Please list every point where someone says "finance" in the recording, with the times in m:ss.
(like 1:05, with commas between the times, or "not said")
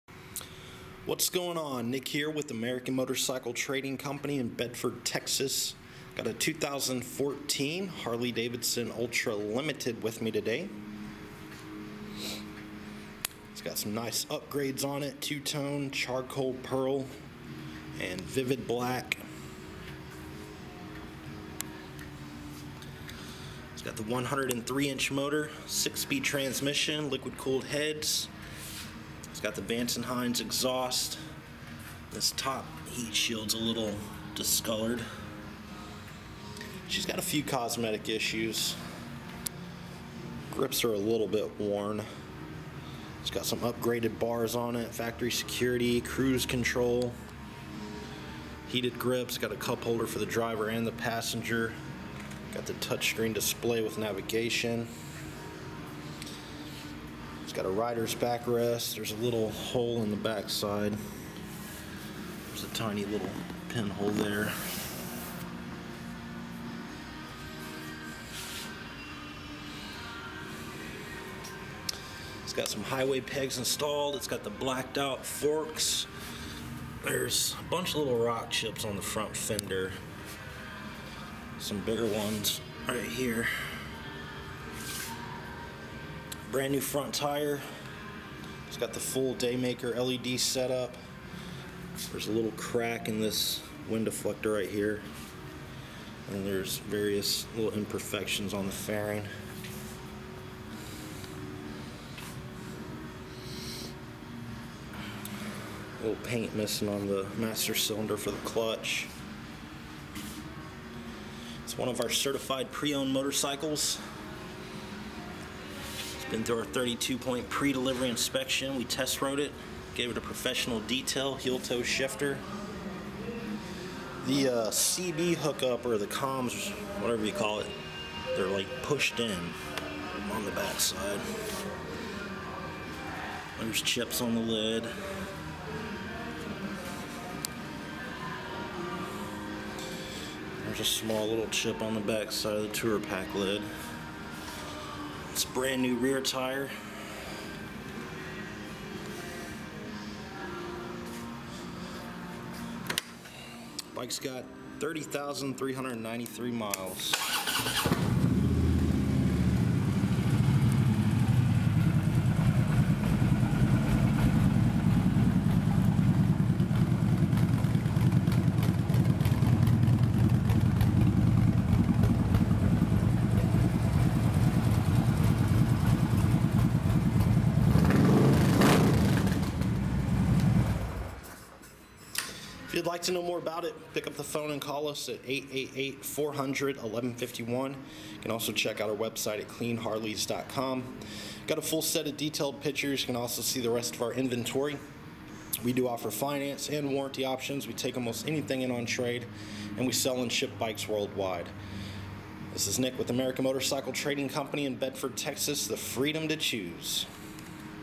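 3:16.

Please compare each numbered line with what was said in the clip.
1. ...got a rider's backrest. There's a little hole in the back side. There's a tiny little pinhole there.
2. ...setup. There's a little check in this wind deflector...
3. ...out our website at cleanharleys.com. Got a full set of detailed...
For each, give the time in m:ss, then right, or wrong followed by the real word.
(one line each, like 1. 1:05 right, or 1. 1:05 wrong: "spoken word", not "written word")
1. 0:57 right
2. 1:30 wrong: "crack", not "check"
3. 3:08 right.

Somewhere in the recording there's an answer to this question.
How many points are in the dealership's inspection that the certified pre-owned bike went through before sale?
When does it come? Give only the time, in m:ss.
1:56.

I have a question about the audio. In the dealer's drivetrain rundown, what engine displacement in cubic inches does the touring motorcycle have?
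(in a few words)
103 inch.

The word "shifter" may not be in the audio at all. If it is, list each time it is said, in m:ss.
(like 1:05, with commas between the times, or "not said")
2:01.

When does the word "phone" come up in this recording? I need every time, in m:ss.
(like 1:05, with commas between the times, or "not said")
3:04.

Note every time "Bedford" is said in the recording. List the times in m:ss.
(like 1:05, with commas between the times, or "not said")
0:04, 3:24.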